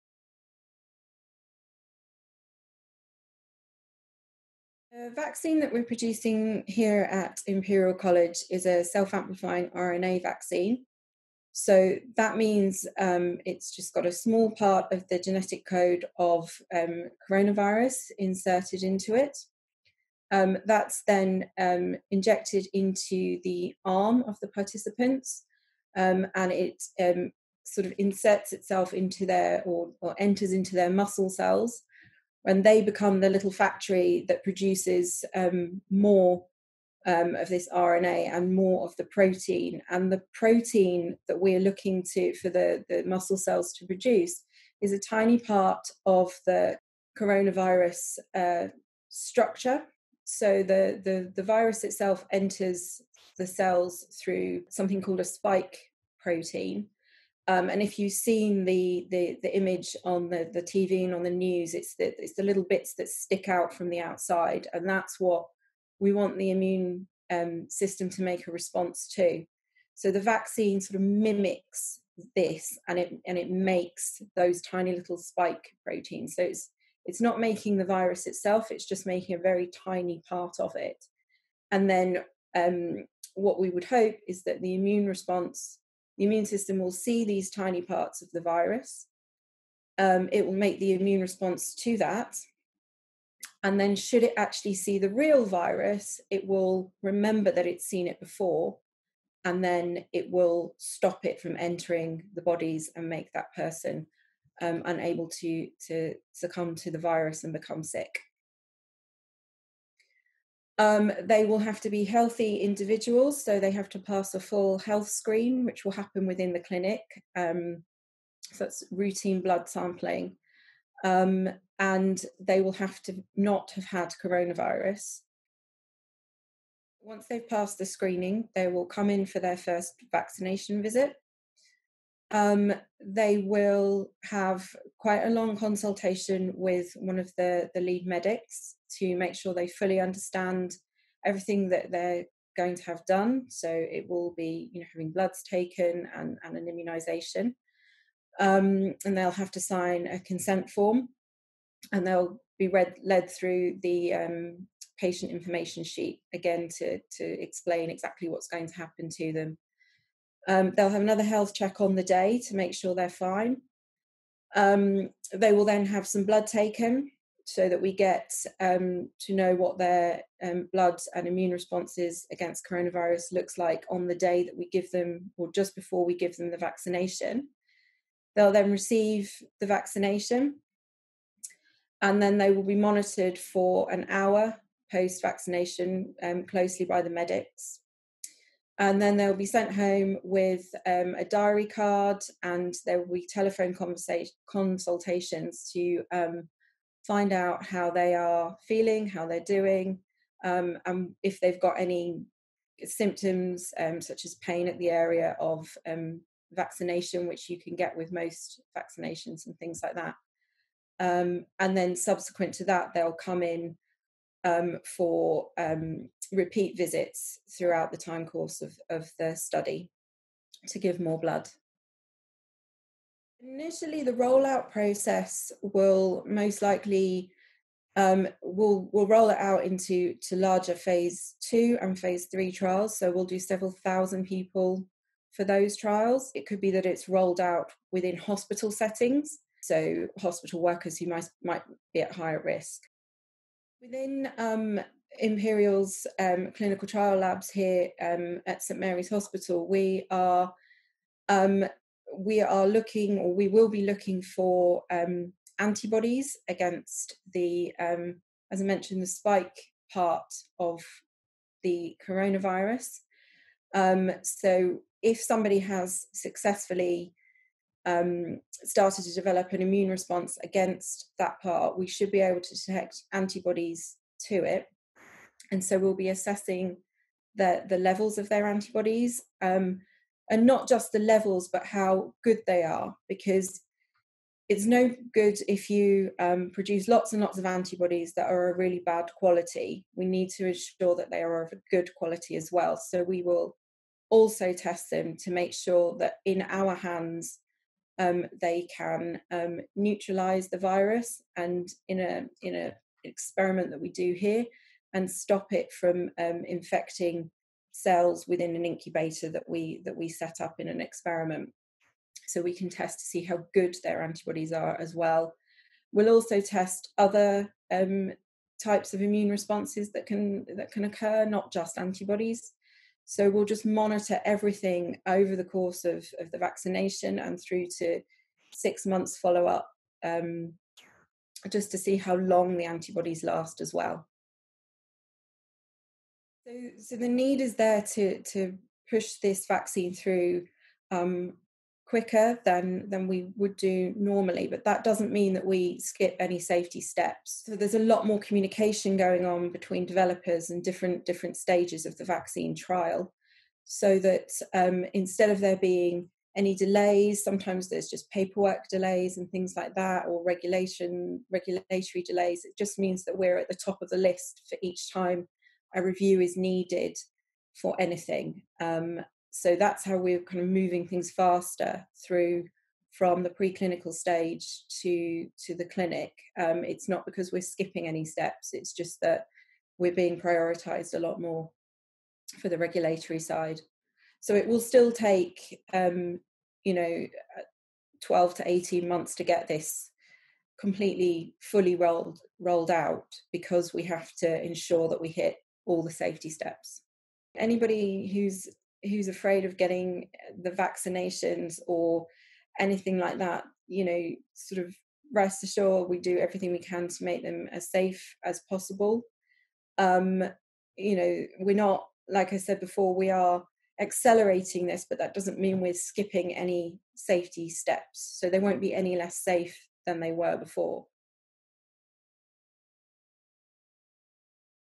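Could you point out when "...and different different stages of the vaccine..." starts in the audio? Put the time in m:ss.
5:50.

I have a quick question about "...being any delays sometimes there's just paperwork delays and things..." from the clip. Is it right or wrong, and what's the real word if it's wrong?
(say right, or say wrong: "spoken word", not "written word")
right.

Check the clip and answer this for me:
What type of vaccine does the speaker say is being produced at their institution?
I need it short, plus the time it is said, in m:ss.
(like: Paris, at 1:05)
Self amplifying RNA vaccine, at 0:08.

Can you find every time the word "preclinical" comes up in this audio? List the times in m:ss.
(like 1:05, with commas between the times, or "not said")
6:13.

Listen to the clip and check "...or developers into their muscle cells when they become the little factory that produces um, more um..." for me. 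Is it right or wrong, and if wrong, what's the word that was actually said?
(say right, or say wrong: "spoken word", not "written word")
wrong: "enters", not "developers".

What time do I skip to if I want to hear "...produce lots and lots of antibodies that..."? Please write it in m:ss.
4:46.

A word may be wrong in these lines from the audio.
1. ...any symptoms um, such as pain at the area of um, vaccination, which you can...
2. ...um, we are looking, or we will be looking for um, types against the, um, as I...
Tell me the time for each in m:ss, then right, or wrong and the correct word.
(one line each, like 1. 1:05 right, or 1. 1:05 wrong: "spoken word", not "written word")
1. 3:21 right
2. 4:11 wrong: "antibodies", not "types".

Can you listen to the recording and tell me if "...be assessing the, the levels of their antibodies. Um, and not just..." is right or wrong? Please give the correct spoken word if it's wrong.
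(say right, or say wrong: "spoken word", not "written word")
right.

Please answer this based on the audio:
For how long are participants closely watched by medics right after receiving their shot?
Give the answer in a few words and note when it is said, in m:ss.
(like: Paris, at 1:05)
An hour, at 3:03.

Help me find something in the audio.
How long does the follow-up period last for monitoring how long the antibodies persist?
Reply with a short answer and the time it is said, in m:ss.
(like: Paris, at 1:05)
6 months, at 5:28.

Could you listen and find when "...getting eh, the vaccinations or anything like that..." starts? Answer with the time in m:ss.
6:39.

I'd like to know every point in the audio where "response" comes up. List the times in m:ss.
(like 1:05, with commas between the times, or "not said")
1:08, 1:25, 1:31, 2:51, 4:29, 5:19.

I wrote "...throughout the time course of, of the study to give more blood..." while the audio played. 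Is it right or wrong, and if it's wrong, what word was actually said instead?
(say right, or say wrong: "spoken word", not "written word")
right.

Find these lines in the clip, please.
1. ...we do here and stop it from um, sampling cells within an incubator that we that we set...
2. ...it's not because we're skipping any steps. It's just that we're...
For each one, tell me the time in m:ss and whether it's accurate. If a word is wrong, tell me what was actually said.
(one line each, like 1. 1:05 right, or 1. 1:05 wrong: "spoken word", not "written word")
1. 5:03 wrong: "infecting", not "sampling"
2. 6:16 right.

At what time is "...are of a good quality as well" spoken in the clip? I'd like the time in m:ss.
4:51.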